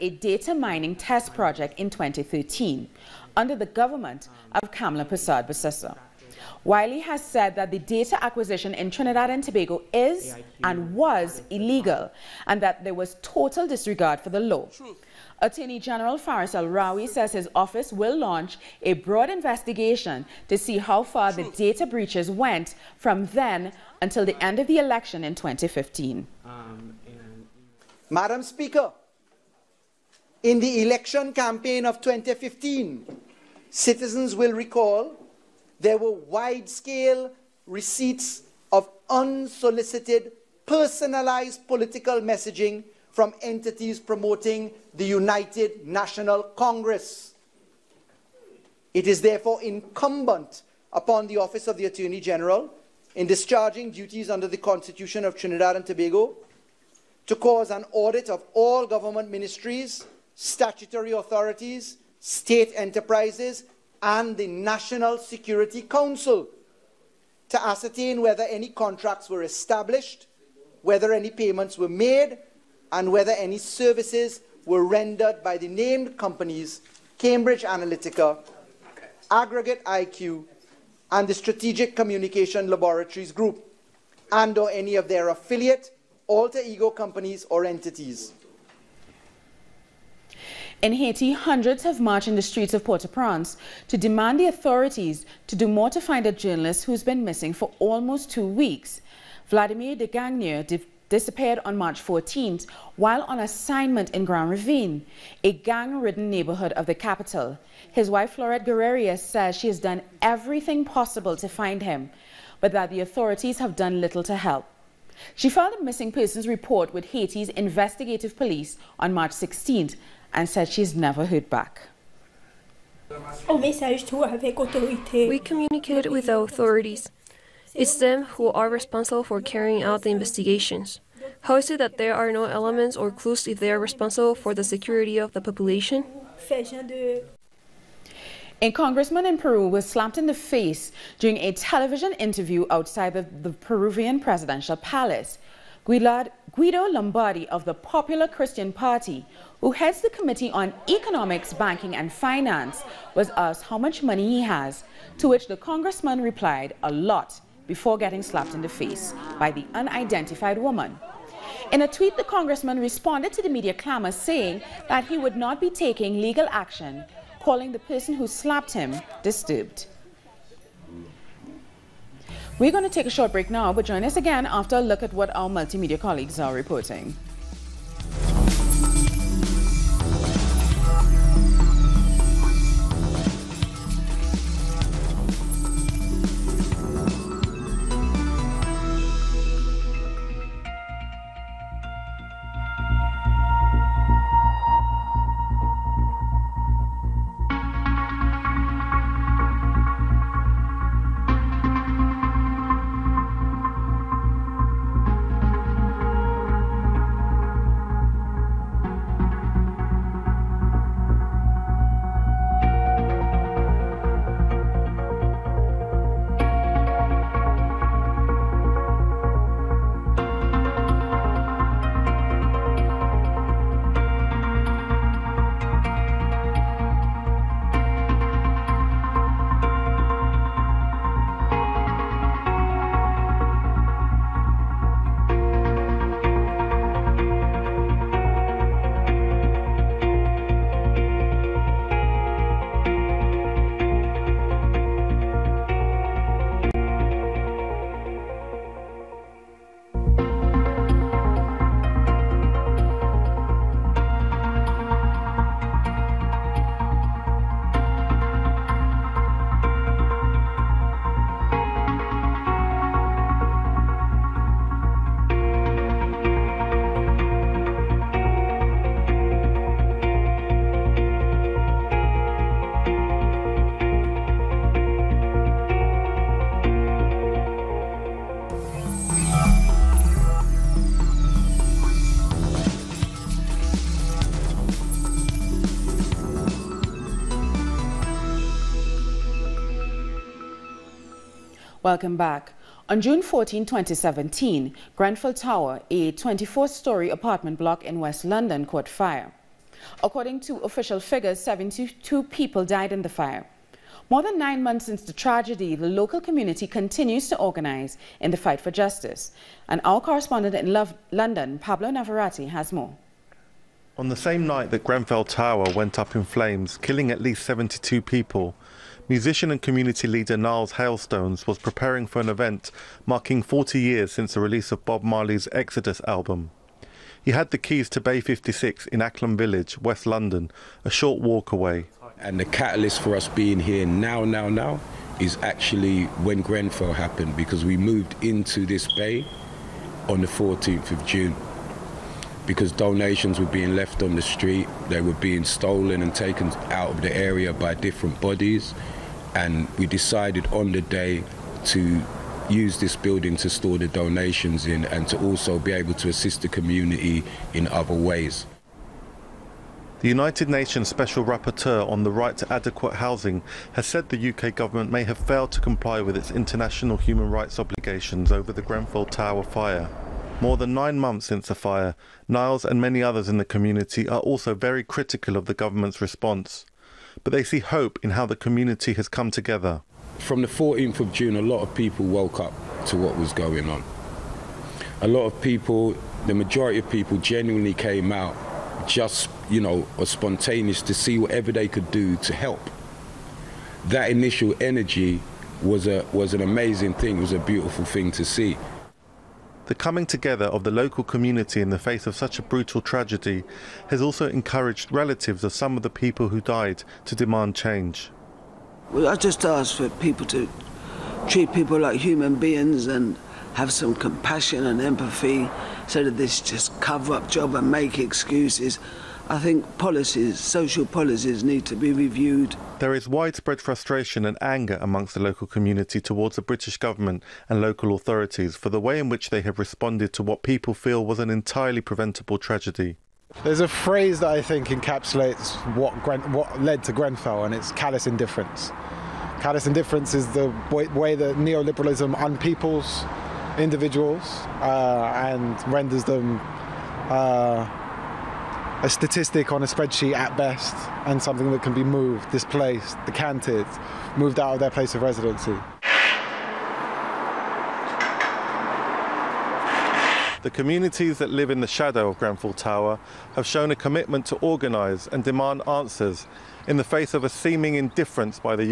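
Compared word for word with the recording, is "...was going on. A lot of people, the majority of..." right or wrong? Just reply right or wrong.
right.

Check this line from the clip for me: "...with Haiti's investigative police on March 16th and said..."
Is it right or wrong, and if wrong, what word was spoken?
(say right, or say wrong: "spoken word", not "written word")
right.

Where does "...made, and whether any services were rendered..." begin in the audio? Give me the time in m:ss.
1:11.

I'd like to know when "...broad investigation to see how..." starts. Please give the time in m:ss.
0:18.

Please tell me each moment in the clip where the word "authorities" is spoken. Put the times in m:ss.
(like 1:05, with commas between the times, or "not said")
1:01, 1:34, 1:53, 2:06, 7:07.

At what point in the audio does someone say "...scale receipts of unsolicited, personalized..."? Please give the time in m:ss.
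0:36.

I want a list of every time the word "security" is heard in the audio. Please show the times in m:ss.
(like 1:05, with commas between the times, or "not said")
1:05, 2:14.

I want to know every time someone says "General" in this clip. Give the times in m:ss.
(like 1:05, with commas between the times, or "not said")
0:15, 0:52.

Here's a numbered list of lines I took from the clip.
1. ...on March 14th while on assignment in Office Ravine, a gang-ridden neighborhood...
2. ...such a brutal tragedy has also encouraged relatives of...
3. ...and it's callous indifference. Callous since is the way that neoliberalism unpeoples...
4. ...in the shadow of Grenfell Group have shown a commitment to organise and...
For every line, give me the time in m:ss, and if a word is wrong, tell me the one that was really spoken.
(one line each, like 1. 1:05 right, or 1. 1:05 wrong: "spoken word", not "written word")
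1. 1:41 wrong: "Grand", not "Office"
2. 6:42 right
3. 7:17 wrong: "indifference", not "since"
4. 7:41 wrong: "Tower", not "Group".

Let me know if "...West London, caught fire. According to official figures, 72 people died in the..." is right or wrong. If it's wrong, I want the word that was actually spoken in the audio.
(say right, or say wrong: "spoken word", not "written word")
right.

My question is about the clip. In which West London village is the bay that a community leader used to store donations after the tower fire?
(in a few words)
Acklam Village.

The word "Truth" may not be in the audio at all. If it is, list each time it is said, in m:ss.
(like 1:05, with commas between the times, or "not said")
0:14, 0:21.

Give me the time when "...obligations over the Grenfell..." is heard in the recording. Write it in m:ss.
6:07.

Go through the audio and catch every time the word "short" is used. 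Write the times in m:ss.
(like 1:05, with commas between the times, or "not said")
2:53, 5:30.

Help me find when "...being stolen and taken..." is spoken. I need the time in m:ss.
5:45.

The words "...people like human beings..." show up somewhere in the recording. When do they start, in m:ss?
6:51.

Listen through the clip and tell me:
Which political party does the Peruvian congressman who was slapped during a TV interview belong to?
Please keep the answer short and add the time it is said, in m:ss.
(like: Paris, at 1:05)
Popular Christian Party, at 2:27.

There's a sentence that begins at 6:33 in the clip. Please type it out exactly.
That initial energy was a was an amazing thing.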